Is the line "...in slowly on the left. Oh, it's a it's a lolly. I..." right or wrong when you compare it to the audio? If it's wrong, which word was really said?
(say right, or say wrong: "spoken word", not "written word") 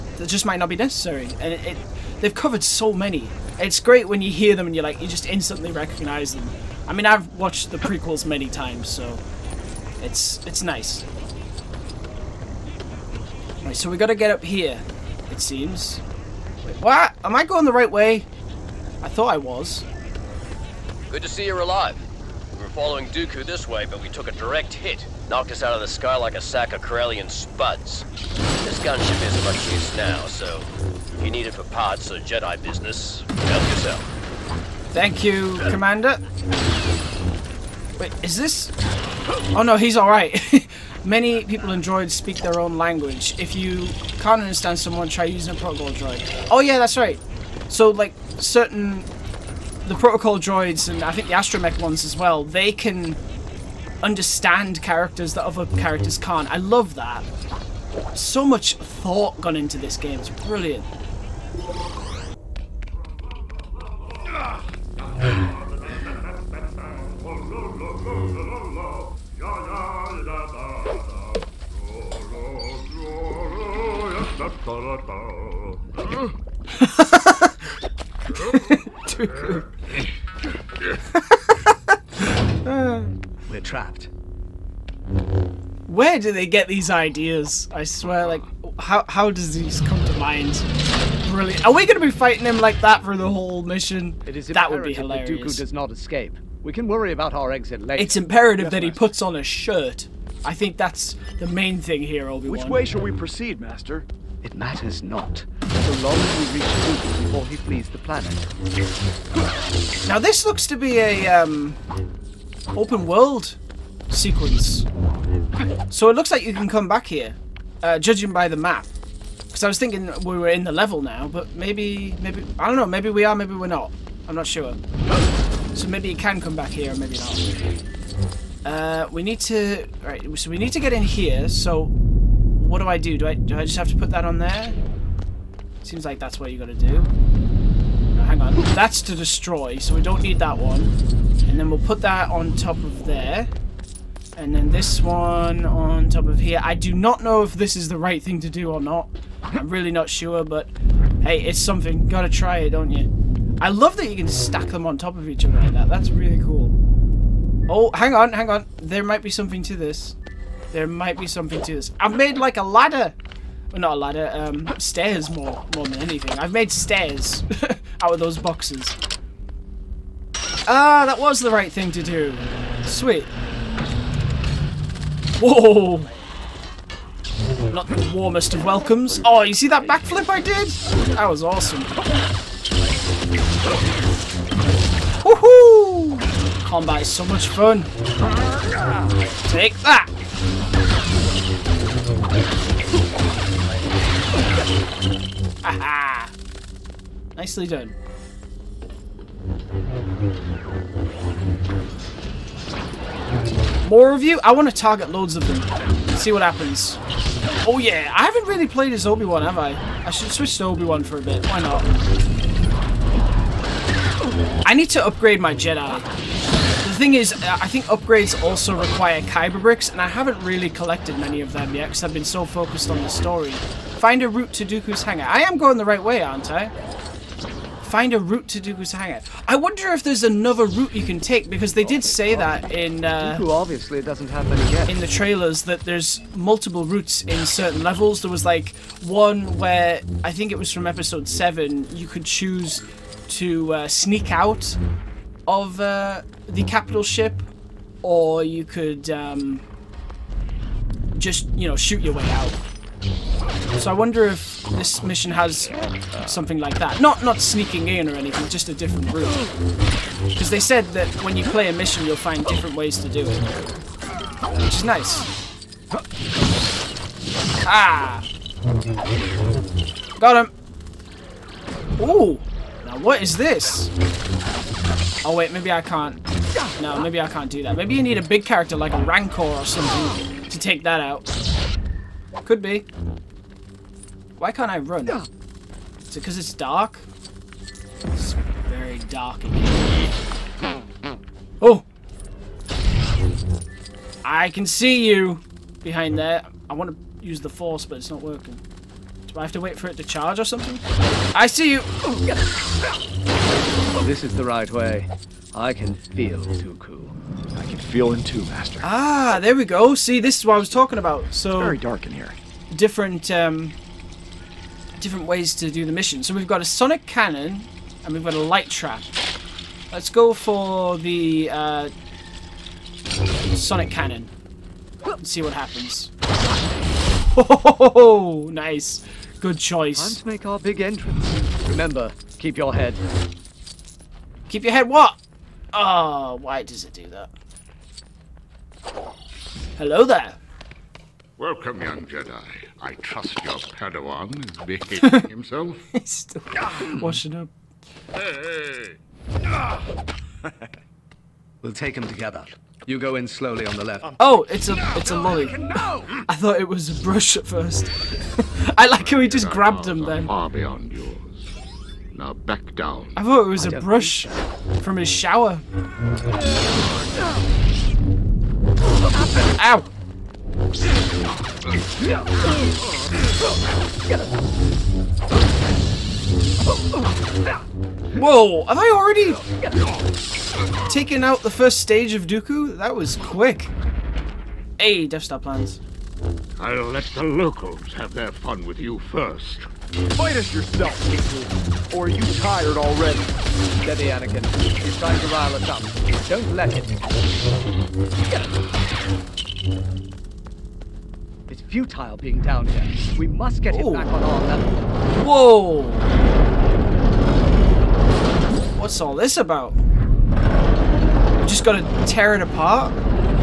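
right.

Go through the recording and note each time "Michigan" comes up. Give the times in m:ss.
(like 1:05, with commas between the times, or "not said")
not said.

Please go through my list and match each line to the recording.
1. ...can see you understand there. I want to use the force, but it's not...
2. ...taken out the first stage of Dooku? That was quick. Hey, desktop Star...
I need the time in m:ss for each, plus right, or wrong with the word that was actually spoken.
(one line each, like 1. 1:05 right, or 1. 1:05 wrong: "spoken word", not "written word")
1. 4:54 wrong: "behind", not "understand"
2. 6:20 right.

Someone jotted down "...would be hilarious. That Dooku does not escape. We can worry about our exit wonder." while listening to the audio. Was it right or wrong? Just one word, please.
wrong.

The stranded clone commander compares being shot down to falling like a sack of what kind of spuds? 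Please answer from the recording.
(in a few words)
Corellian.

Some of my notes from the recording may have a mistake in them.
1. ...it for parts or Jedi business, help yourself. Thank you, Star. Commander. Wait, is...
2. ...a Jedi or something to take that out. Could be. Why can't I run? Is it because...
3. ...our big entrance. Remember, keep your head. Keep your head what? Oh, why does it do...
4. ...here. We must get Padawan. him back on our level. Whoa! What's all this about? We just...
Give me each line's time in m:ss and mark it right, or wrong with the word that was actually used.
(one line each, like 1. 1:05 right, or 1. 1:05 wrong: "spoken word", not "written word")
1. 0:31 wrong: "Jedi", not "Star"
2. 4:38 wrong: "Rancor", not "Jedi"
3. 5:30 right
4. 6:42 wrong: "Ooh", not "Padawan".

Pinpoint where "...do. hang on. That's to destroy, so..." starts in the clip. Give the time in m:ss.
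2:16.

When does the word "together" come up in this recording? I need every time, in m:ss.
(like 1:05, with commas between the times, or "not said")
5:52.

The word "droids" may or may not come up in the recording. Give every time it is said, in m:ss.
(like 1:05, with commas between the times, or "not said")
0:41, 0:45, 0:50.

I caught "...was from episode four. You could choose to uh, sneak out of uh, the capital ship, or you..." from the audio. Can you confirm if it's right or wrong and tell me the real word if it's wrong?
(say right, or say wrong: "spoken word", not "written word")
wrong: "seven", not "four".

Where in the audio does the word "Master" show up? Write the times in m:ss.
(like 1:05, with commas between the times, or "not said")
1:43, 5:08.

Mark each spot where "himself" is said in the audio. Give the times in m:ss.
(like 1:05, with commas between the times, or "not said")
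5:45.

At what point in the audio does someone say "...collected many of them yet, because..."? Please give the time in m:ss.
3:40.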